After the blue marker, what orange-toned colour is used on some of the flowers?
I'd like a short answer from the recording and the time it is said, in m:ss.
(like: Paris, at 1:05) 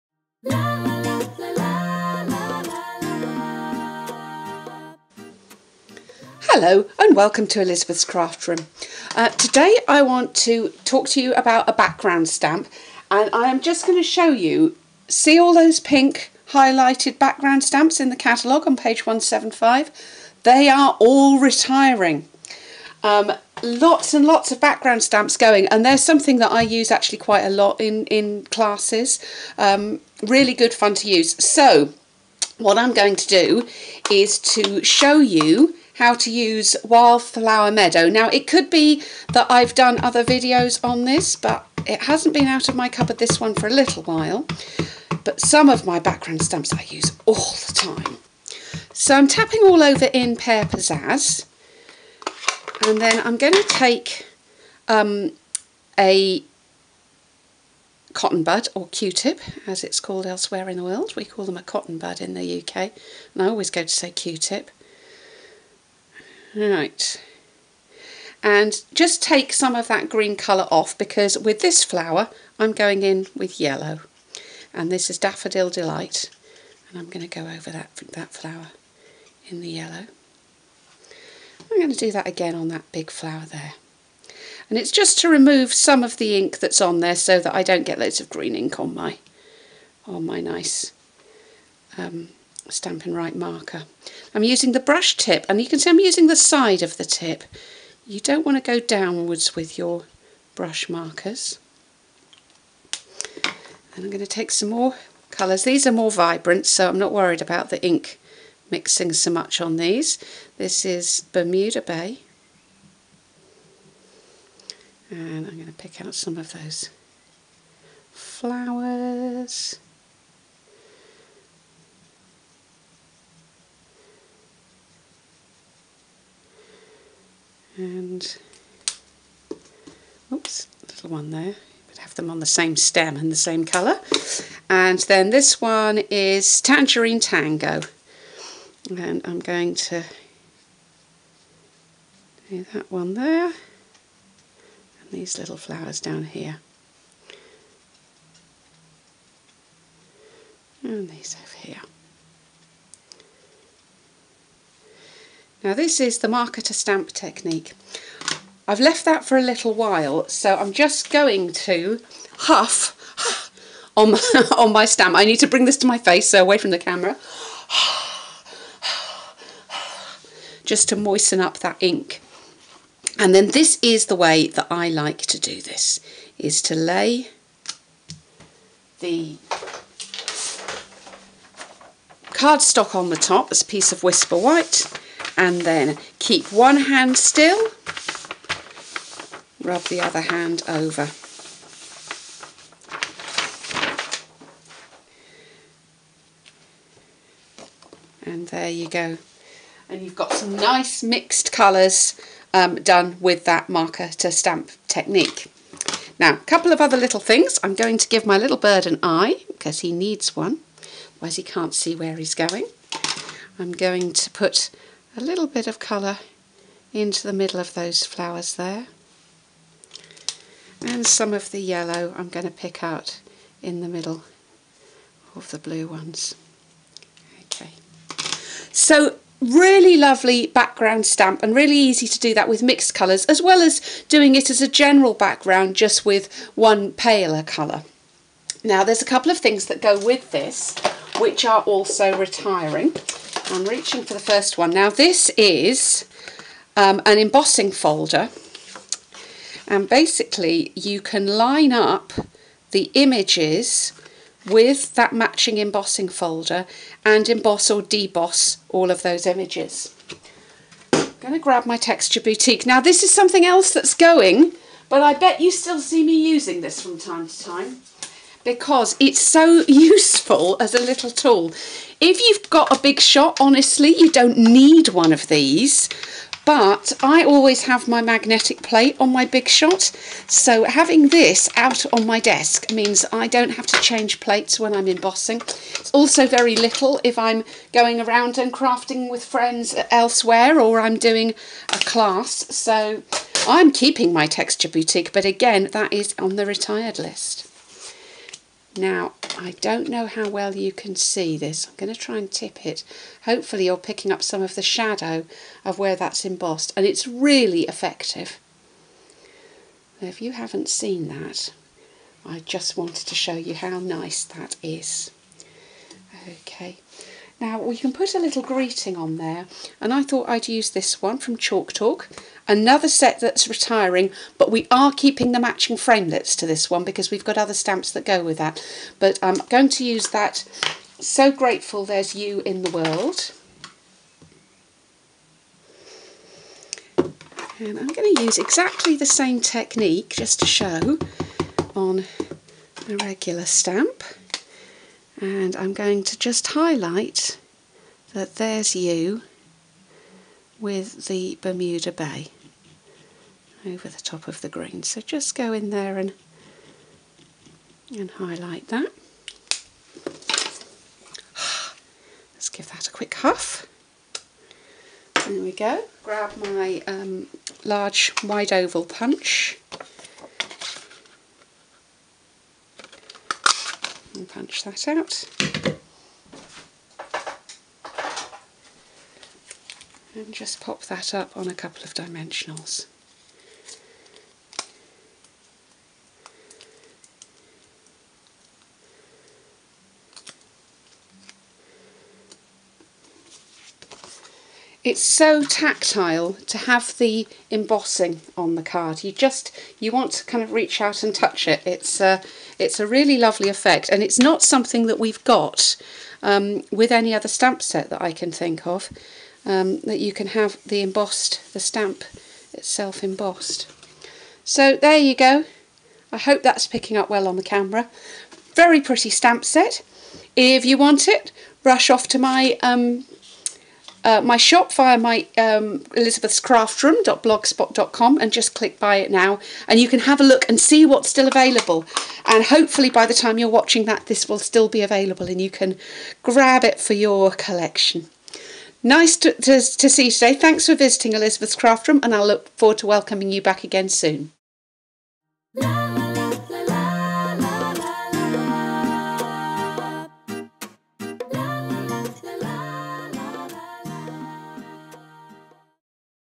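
Tangerine Tango, at 2:16.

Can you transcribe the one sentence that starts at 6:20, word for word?
And just pop that up on a couple of dimensionals.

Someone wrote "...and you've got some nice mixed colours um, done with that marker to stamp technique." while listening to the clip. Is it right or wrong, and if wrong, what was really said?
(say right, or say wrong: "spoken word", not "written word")
right.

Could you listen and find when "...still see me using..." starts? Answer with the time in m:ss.
4:25.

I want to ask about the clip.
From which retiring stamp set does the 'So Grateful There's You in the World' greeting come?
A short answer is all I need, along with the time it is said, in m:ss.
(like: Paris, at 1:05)
Chalk Talk, at 5:21.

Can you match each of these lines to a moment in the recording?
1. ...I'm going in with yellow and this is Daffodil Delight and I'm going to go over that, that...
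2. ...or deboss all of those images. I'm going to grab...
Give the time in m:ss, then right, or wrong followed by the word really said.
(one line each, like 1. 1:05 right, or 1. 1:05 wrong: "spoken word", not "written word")
1. 1:12 right
2. 4:17 right.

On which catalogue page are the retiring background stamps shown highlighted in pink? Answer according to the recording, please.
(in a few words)
175.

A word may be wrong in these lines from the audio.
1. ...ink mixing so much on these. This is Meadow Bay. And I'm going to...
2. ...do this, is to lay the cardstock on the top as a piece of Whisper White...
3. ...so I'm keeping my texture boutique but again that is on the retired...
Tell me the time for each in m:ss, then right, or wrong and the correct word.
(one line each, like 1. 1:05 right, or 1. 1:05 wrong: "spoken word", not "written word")
1. 1:47 wrong: "Bermuda", not "Meadow"
2. 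2:55 right
3. 4:52 right.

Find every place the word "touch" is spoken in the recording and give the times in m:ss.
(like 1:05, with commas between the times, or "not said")
6:41.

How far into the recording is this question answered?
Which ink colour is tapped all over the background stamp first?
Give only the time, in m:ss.
0:50.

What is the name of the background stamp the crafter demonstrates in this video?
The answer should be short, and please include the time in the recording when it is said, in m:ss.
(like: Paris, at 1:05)
Wildflower Meadow, at 0:36.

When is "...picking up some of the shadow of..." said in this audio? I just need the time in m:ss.
5:03.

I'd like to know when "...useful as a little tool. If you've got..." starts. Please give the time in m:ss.
4:29.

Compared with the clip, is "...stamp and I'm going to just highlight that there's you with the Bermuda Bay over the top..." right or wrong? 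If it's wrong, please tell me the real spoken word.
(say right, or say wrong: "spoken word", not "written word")
right.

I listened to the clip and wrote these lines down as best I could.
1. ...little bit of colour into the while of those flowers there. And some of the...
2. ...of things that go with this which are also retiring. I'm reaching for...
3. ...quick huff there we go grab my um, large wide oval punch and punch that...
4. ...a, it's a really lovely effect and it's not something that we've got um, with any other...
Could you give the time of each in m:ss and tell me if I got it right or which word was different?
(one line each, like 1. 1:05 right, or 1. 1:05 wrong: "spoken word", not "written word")
1. 3:35 wrong: "middle", not "while"
2. 3:59 right
3. 6:02 right
4. 6:42 right.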